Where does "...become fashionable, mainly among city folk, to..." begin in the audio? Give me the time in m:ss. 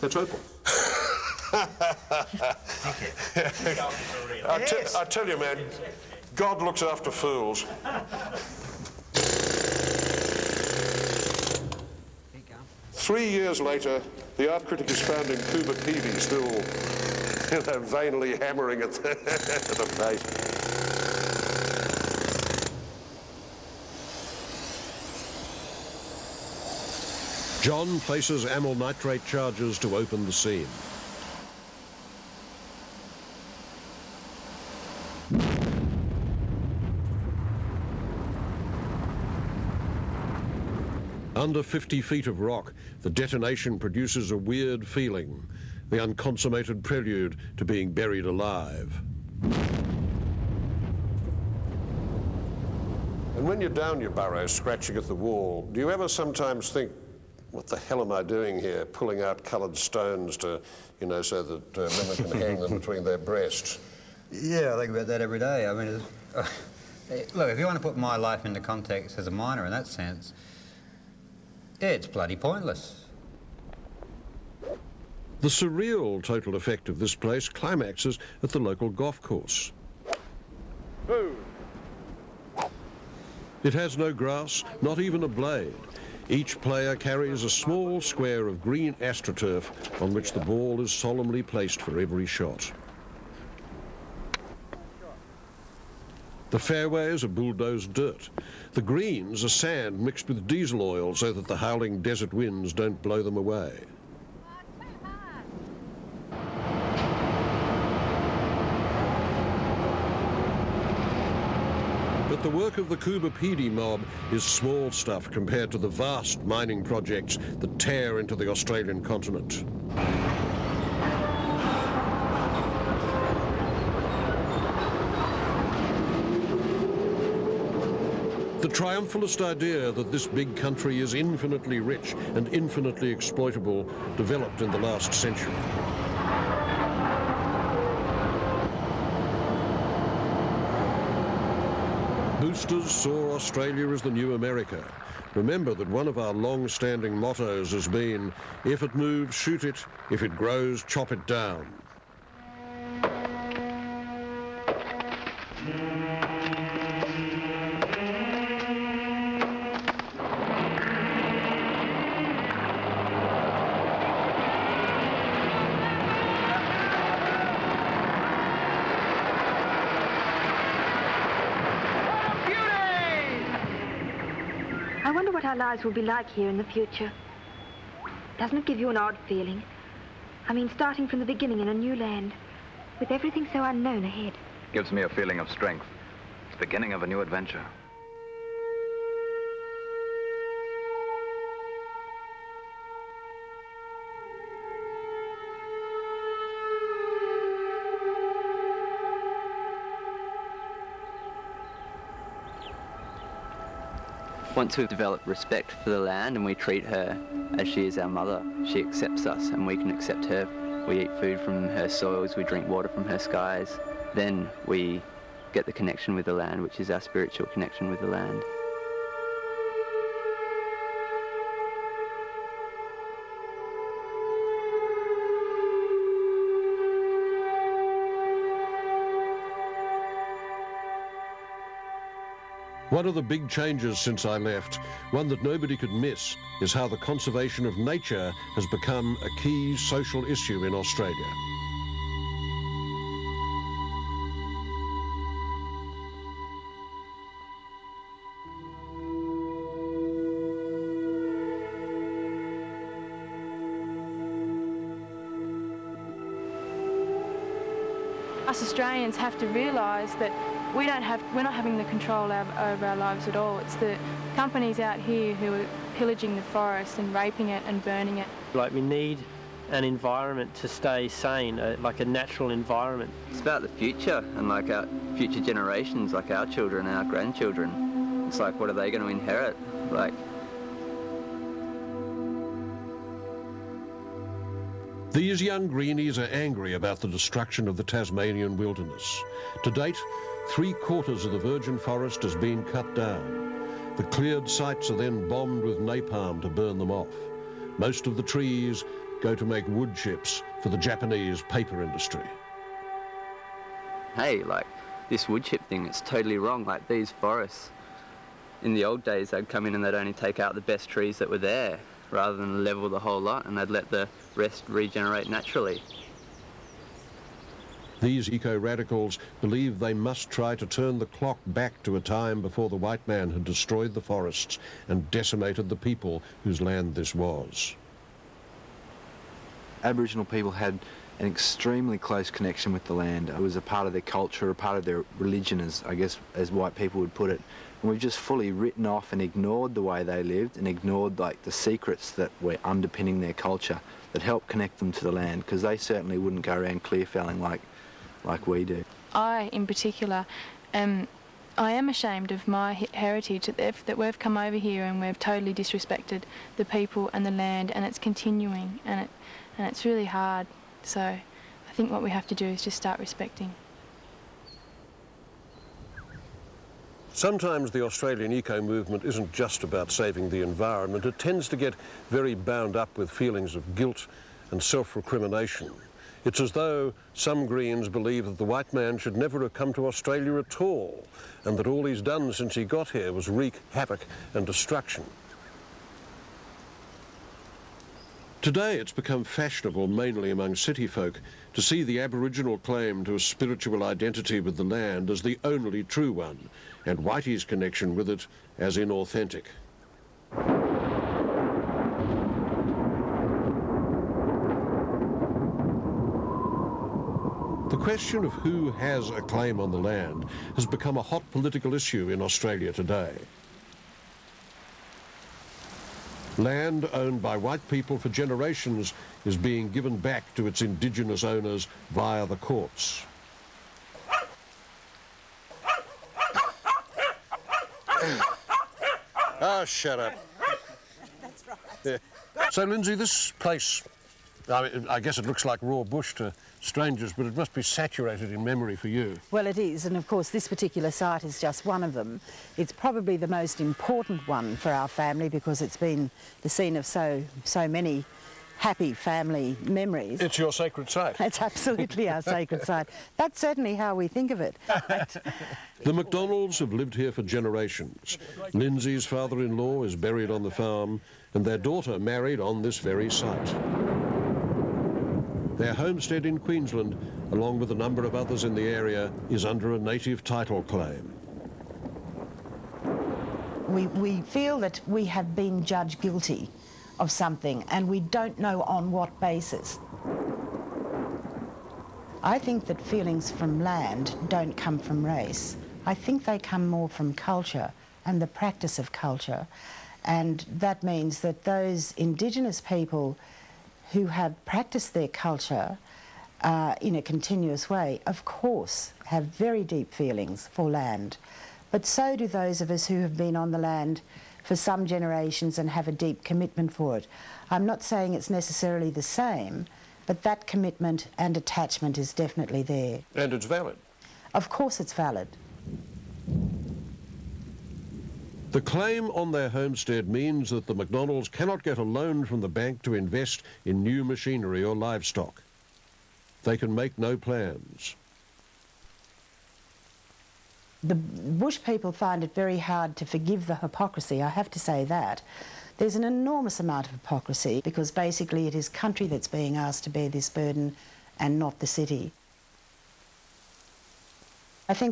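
6:28.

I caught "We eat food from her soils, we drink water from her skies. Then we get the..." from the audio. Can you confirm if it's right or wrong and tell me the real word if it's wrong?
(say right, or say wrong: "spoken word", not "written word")
right.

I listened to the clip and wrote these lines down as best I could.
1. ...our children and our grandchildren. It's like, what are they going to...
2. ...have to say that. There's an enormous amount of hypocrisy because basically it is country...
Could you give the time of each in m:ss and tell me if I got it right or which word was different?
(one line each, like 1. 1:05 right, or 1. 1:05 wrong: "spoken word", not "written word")
1. 4:36 right
2. 8:54 right.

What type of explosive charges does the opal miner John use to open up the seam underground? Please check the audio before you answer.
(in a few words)
amyl nitrate.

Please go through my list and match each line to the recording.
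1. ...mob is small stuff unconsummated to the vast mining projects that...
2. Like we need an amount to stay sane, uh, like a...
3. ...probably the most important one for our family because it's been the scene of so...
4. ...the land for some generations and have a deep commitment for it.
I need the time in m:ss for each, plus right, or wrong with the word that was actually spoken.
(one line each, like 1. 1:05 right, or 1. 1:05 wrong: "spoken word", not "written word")
1. 1:53 wrong: "compared", not "unconsummated"
2. 4:28 wrong: "environment", not "amount"
3. 7:22 right
4. 8:23 right.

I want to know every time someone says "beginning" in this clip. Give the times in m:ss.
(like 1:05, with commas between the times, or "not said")
3:01, 3:06.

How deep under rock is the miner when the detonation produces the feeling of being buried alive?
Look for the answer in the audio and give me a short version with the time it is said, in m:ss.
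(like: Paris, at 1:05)
50 feet, at 0:41.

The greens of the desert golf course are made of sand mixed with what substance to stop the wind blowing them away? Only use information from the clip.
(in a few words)
diesel oil.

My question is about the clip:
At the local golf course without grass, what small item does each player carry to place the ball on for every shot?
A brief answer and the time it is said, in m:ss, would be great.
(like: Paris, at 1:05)
astroturf, at 1:28.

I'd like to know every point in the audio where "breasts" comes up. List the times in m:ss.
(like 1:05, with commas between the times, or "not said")
1:03.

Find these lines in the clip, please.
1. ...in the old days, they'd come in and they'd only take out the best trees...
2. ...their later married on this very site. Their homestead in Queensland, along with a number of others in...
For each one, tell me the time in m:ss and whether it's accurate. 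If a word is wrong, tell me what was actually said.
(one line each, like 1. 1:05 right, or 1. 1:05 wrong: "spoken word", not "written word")
1. 5:08 right
2. 7:41 wrong: "daughter", not "later".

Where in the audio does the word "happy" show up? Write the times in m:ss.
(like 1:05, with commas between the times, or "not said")
7:28.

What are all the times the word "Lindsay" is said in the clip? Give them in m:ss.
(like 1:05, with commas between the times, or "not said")
7:12, 7:38.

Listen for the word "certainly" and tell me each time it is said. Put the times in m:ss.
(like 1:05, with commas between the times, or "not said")
5:45, 7:33.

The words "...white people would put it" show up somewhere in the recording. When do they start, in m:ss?
5:36.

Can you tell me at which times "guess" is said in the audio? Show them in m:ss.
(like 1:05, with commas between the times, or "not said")
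5:35, 7:15.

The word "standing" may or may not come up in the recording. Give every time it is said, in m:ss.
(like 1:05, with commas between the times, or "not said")
2:26.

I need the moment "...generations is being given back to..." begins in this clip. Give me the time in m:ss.
6:58.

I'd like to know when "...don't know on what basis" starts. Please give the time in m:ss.
7:58.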